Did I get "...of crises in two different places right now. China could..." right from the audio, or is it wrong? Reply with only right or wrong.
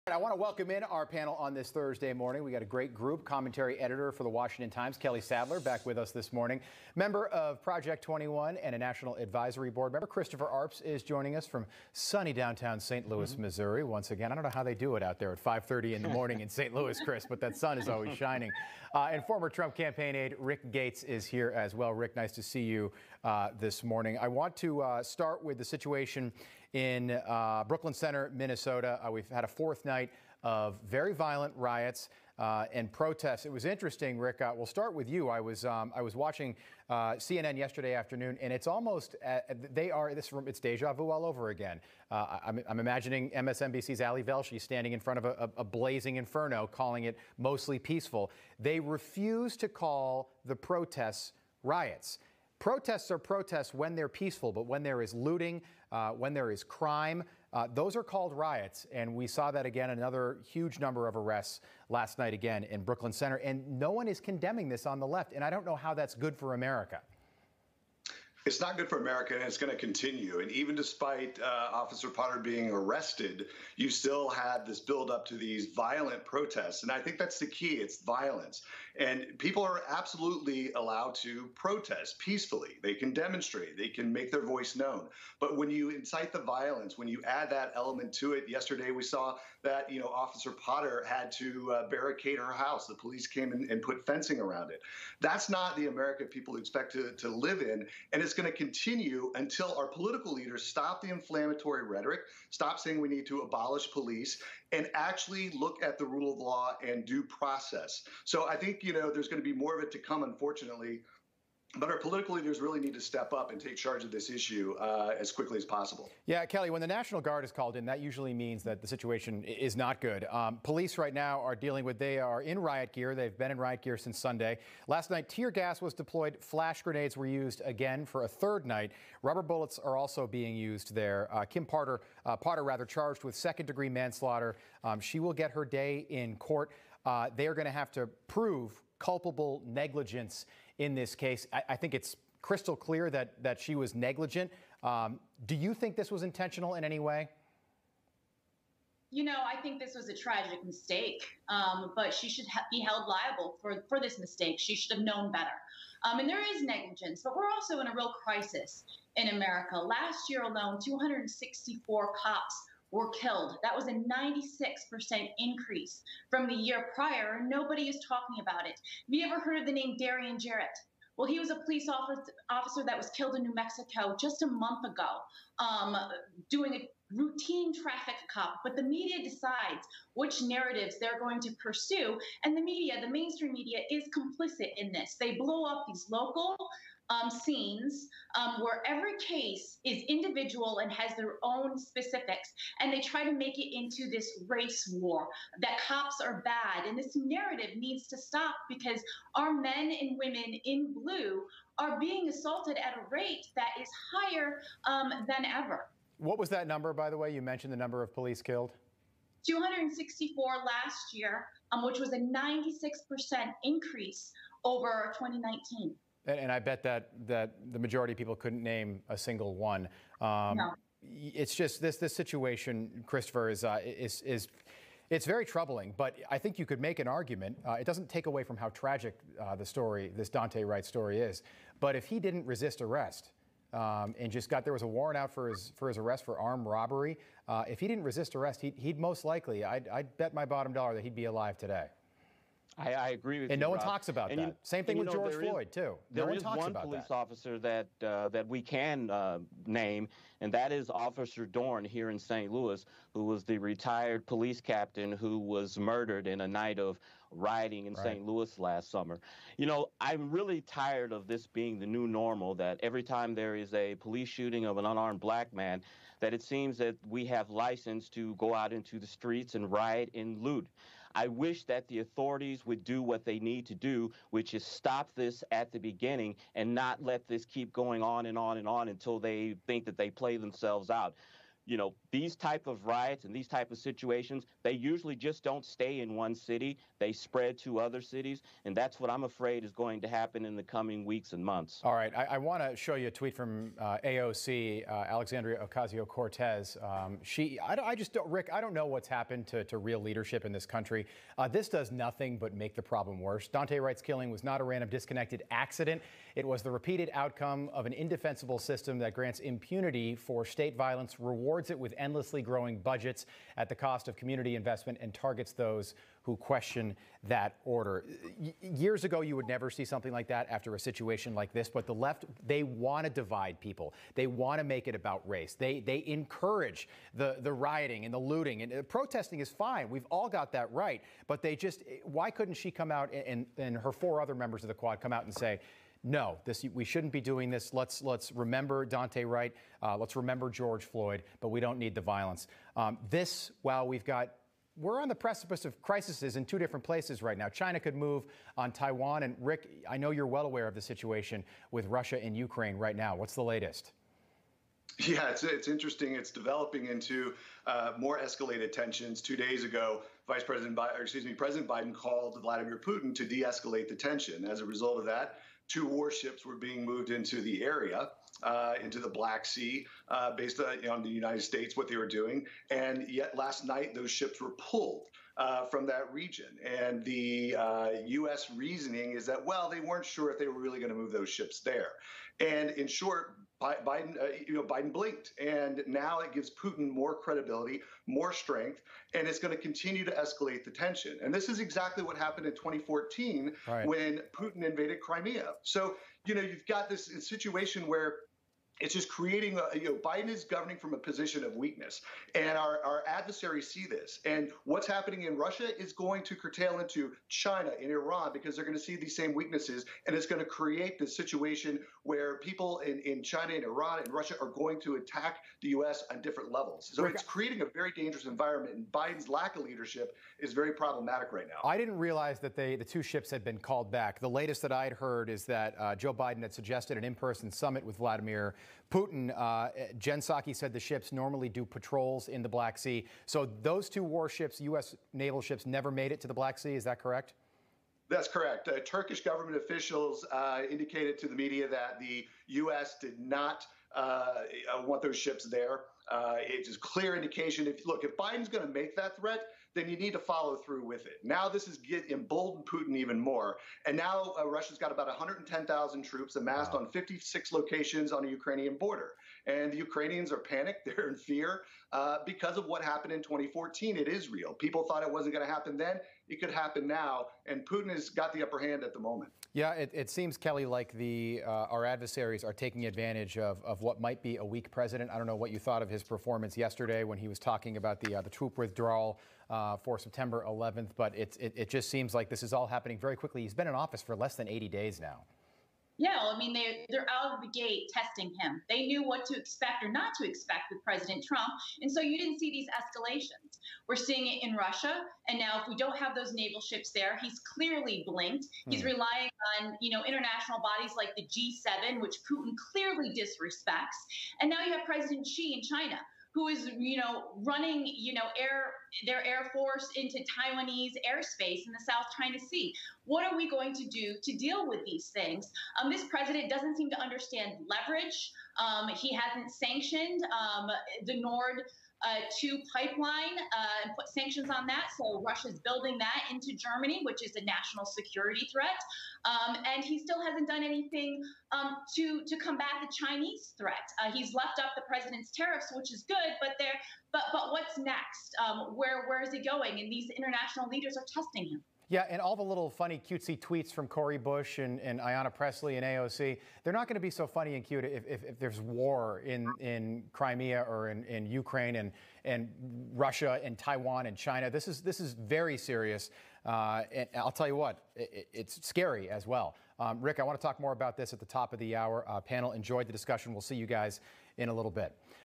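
right.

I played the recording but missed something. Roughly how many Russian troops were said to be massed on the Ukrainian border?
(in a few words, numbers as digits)
110,000.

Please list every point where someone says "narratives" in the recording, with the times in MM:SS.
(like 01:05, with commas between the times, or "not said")
03:00, 03:17.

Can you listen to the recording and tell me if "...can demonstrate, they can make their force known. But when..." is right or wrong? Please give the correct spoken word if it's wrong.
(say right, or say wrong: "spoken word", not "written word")
wrong: "voice", not "force".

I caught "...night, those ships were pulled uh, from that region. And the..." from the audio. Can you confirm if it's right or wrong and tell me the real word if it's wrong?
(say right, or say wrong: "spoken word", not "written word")
right.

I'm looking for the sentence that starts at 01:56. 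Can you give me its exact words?
Yeah, Kelly, when the National Guard is called in, that usually means that the situation is not good.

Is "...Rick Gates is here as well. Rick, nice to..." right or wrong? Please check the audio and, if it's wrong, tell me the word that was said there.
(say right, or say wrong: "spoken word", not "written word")
right.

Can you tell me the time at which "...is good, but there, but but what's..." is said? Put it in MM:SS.
08:55.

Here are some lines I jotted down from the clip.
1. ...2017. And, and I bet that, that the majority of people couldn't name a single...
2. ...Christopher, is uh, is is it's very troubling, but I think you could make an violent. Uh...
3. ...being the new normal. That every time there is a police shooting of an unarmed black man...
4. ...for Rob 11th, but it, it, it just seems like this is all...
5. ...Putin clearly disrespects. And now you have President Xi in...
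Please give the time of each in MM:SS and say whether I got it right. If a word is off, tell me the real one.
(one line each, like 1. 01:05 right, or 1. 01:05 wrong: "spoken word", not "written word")
1. 03:35 wrong: "2019", not "2017"
2. 03:43 wrong: "argument", not "violent"
3. 04:21 right
4. 07:59 wrong: "September", not "Rob"
5. 08:22 right.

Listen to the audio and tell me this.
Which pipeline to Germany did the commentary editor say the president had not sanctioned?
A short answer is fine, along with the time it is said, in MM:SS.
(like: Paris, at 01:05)
Nord 2 pipeline, at 08:41.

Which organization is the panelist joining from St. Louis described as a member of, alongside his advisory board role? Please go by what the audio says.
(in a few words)
Project 21.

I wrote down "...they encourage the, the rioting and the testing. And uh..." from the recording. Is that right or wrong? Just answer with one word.
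wrong.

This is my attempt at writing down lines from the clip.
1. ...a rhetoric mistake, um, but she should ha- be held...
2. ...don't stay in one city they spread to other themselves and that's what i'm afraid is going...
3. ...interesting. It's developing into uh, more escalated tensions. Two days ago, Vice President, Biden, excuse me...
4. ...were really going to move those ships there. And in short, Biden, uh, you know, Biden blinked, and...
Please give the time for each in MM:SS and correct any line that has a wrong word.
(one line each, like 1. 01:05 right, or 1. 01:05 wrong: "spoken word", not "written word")
1. 02:30 wrong: "tragic", not "rhetoric"
2. 04:45 wrong: "cities", not "themselves"
3. 05:55 right
4. 06:20 right.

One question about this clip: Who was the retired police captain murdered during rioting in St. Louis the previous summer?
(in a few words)
Officer Dorn.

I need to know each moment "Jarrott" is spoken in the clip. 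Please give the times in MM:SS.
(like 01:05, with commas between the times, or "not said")
02:50.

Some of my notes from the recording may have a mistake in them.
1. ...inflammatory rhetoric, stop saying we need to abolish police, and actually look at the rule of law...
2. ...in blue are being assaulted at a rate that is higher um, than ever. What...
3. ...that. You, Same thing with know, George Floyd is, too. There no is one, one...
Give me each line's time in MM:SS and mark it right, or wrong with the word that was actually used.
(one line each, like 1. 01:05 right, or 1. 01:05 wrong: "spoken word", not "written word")
1. 01:41 right
2. 03:20 right
3. 04:04 right.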